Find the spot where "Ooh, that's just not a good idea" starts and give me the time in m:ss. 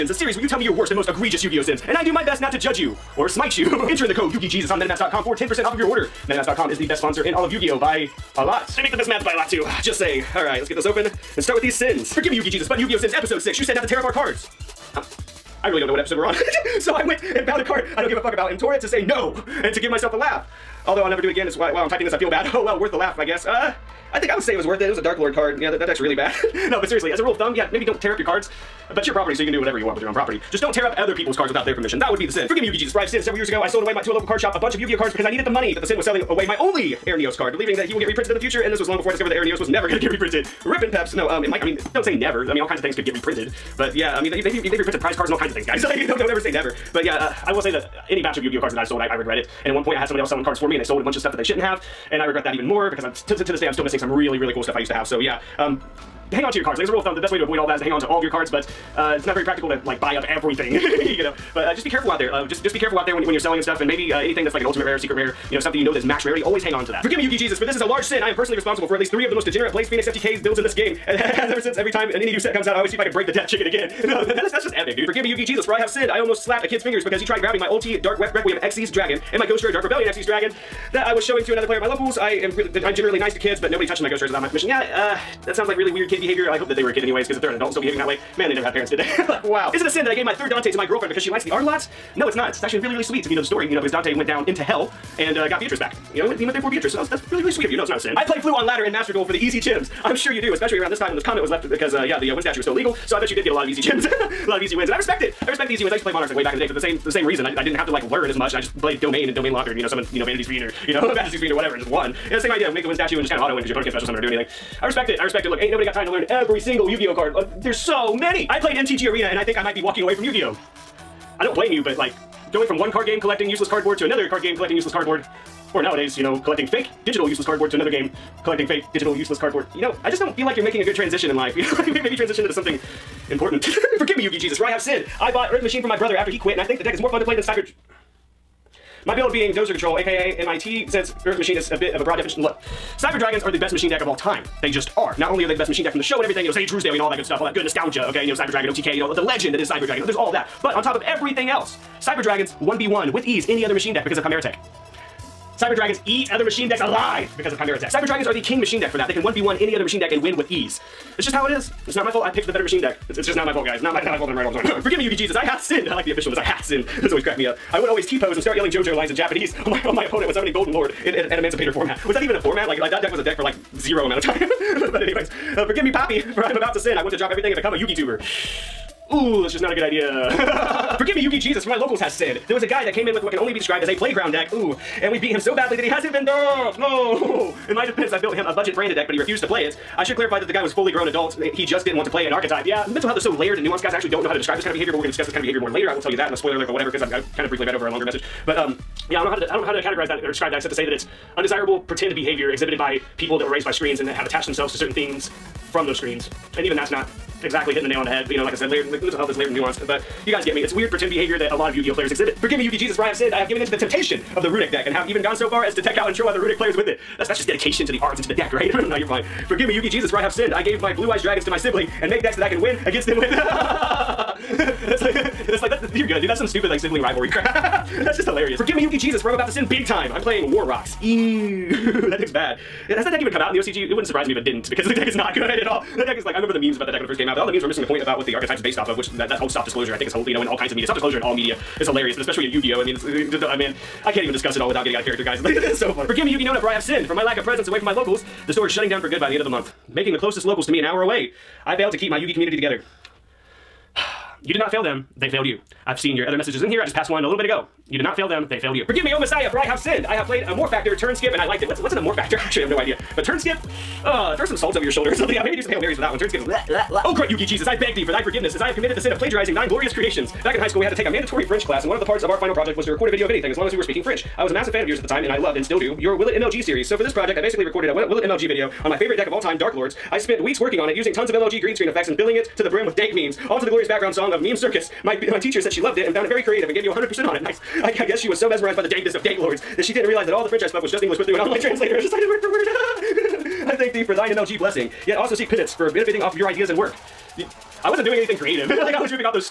2:59.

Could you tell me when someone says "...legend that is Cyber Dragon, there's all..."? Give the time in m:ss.
2:29.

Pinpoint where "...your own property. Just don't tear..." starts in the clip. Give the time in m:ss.
0:30.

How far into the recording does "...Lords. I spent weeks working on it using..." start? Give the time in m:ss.
4:39.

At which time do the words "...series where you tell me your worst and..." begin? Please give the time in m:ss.
0:00.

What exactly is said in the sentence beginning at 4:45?
My, my teacher said she loved it and found it very creative and gave me 100% on it.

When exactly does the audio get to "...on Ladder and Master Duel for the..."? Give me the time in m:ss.
1:38.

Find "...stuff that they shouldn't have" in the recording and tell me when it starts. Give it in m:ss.
0:51.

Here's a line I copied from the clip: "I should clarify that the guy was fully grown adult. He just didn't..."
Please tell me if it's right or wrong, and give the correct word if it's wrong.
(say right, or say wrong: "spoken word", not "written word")
right.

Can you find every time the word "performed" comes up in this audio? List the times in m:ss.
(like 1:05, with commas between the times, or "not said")
not said.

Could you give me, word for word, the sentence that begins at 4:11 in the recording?
I failed to keep my Yugi community together.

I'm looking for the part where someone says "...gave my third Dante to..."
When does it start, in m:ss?
1:30.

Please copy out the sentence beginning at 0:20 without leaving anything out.
Although I'll never do it again, as why while I'm typing this I feel bad.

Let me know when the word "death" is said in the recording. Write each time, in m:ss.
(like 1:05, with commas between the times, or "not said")
1:13.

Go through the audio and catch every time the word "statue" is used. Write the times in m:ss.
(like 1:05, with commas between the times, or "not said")
1:42, 1:52.